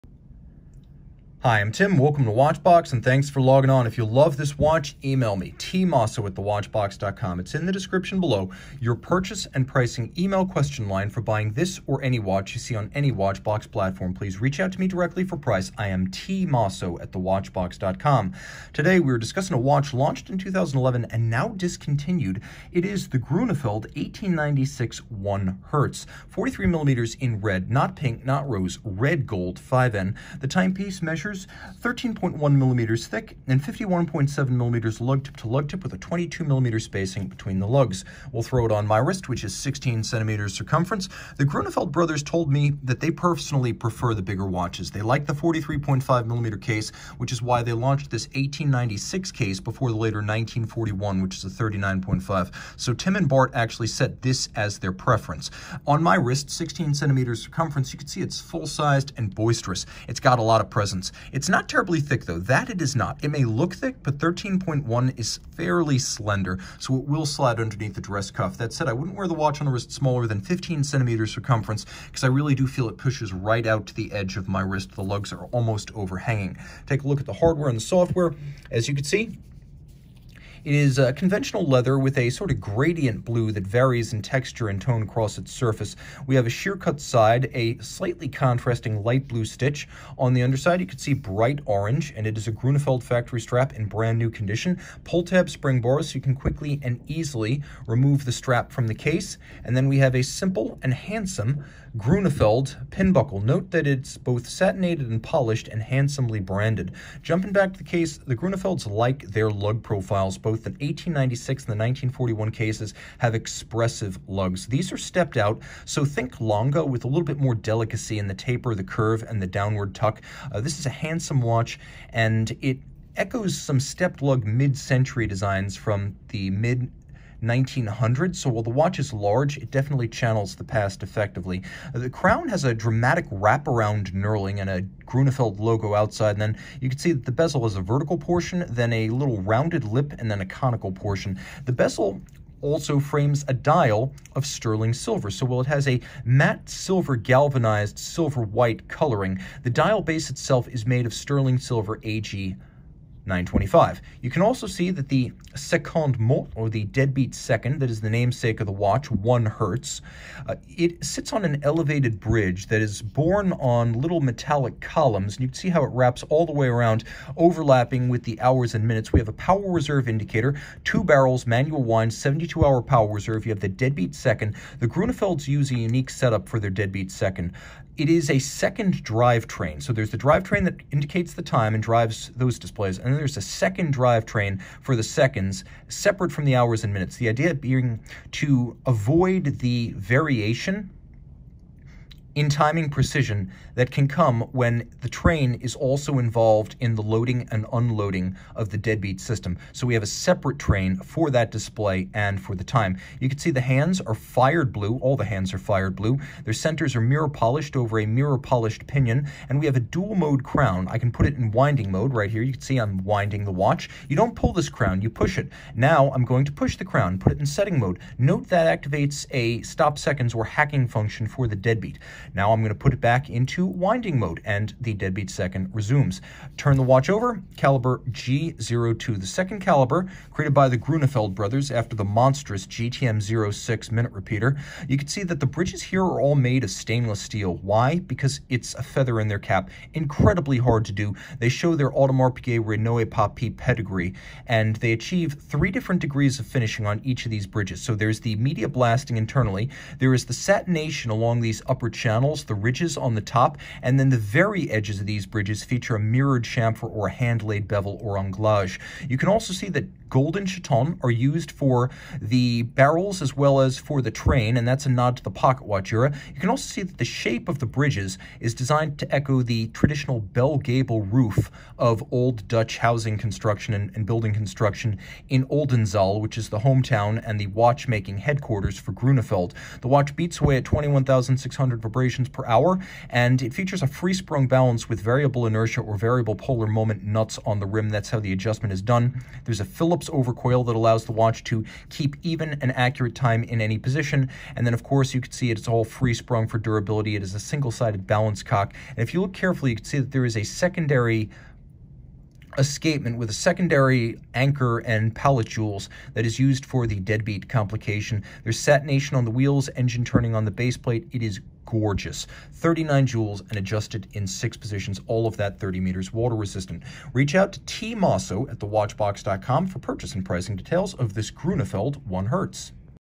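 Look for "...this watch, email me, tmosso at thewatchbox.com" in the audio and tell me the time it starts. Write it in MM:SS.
00:04.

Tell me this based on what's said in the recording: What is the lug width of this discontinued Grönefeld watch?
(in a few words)
22 millimeters.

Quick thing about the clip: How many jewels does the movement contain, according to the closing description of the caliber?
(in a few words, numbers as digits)
39.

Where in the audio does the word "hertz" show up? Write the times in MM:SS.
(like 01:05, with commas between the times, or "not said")
00:25, 02:39, 05:22.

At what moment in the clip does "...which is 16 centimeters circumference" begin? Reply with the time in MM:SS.
00:39.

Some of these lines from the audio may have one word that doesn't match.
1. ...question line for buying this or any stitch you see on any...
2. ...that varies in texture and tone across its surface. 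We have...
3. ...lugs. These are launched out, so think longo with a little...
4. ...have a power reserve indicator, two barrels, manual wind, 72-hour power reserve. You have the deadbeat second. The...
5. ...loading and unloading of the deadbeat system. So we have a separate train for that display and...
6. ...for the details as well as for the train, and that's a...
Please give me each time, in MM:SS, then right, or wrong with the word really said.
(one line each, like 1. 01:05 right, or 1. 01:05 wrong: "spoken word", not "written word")
1. 00:10 wrong: "watch", not "stitch"
2. 01:23 right
3. 01:54 wrong: "stepped", not "launched"
4. 02:49 right
5. 03:17 right
6. 04:21 wrong: "barrels", not "details".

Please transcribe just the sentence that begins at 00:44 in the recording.
They like the 43.5 millimeter case, which is why they launched this 1896 case before the later 1941, which is a 39.5.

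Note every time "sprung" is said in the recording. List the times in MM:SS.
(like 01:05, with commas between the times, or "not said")
04:43, 04:56.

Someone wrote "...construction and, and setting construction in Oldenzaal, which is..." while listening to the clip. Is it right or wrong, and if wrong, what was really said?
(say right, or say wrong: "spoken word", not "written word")
wrong: "building", not "setting".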